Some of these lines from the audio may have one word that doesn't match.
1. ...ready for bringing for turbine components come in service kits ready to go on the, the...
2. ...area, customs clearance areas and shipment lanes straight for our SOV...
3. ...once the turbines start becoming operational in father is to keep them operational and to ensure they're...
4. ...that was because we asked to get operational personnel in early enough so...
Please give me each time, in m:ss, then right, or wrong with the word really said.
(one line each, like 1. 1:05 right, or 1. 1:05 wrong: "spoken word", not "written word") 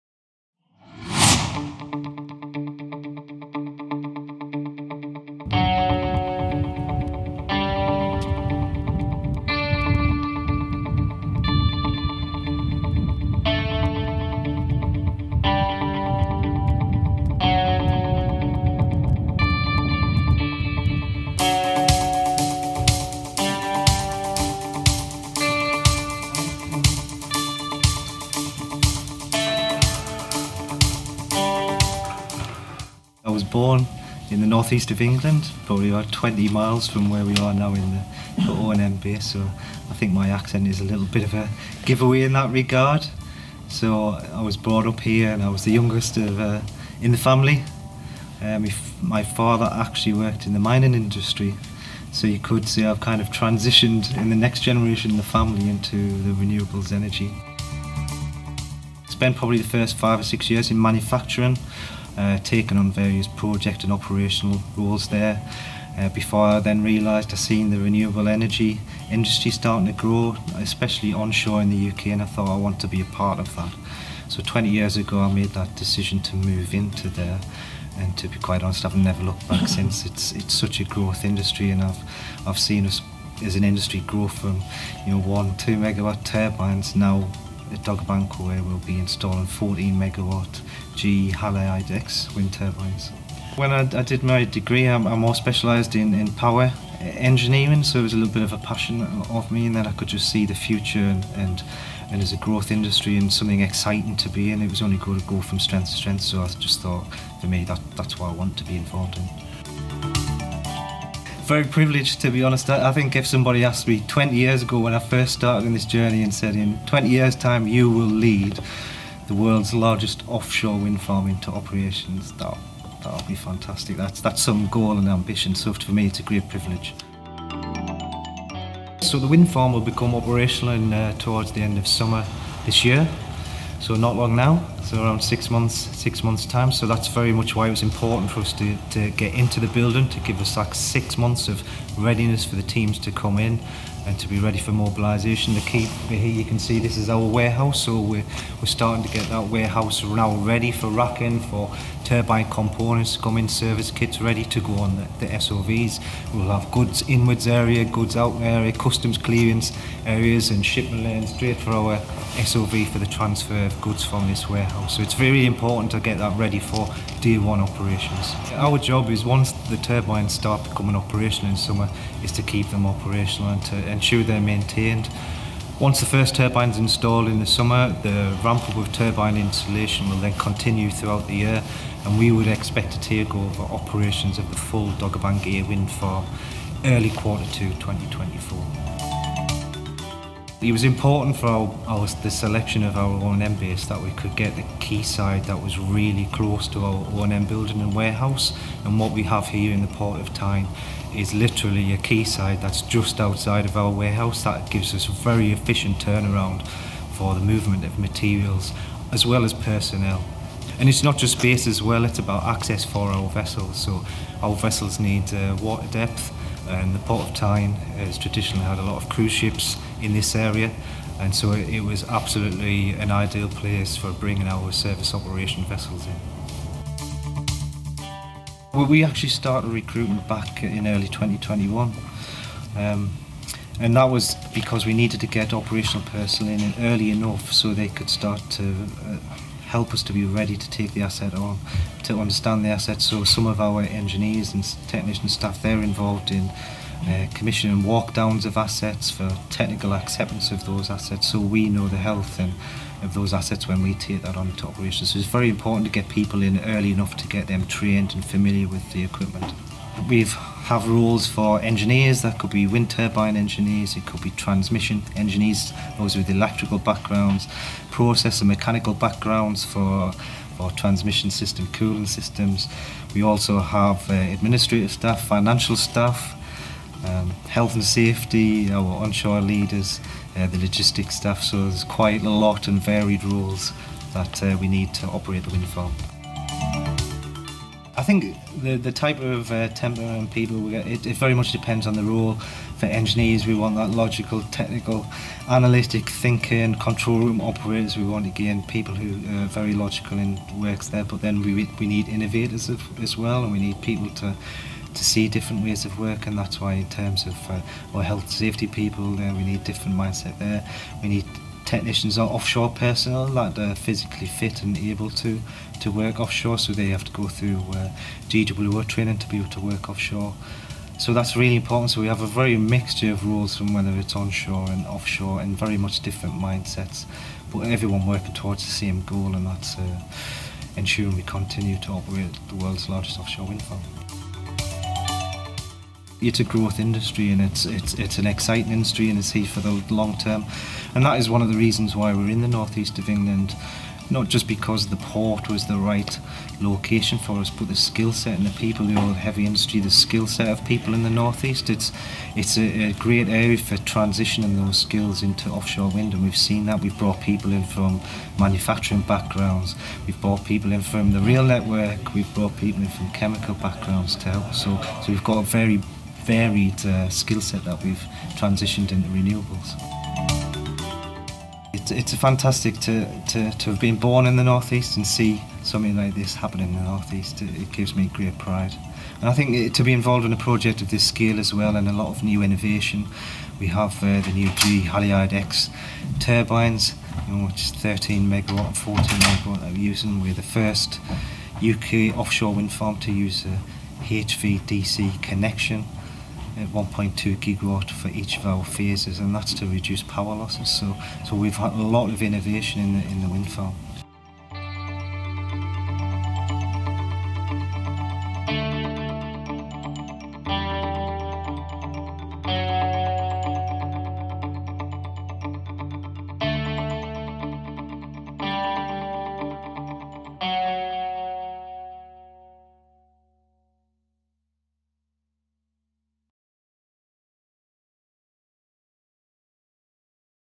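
1. 2:30 wrong: "racking", not "bringing"
2. 2:38 right
3. 2:49 wrong: "summer", not "father"
4. 3:53 wrong: "needed", not "asked".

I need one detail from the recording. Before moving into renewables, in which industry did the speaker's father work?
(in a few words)
Mining.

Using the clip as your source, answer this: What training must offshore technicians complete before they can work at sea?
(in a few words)
GWO training.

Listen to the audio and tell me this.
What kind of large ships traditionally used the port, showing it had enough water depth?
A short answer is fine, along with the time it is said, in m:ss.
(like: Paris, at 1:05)
Cruise ships, at 3:39.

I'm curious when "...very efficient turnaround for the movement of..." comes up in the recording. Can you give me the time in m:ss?
3:25.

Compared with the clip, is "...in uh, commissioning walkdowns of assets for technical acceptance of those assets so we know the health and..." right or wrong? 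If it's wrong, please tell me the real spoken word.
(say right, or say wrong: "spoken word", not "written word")
right.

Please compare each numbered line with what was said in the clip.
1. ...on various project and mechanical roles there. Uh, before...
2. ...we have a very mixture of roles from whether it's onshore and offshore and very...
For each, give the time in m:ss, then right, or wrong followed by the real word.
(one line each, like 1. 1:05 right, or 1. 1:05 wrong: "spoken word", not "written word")
1. 1:02 wrong: "operational", not "mechanical"
2. 5:22 right.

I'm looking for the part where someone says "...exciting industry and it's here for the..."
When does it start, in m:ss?
5:38.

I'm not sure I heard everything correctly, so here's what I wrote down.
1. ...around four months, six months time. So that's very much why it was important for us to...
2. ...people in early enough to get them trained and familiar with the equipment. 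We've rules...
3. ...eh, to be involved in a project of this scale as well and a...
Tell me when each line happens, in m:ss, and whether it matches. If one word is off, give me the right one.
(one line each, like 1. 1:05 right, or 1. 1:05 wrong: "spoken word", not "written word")
1. 2:15 wrong: "six", not "four"
2. 4:16 right
3. 6:19 right.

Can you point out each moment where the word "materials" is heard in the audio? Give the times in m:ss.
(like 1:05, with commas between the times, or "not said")
3:27.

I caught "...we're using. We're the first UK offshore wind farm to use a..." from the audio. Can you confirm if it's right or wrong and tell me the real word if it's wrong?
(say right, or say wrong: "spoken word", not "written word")
right.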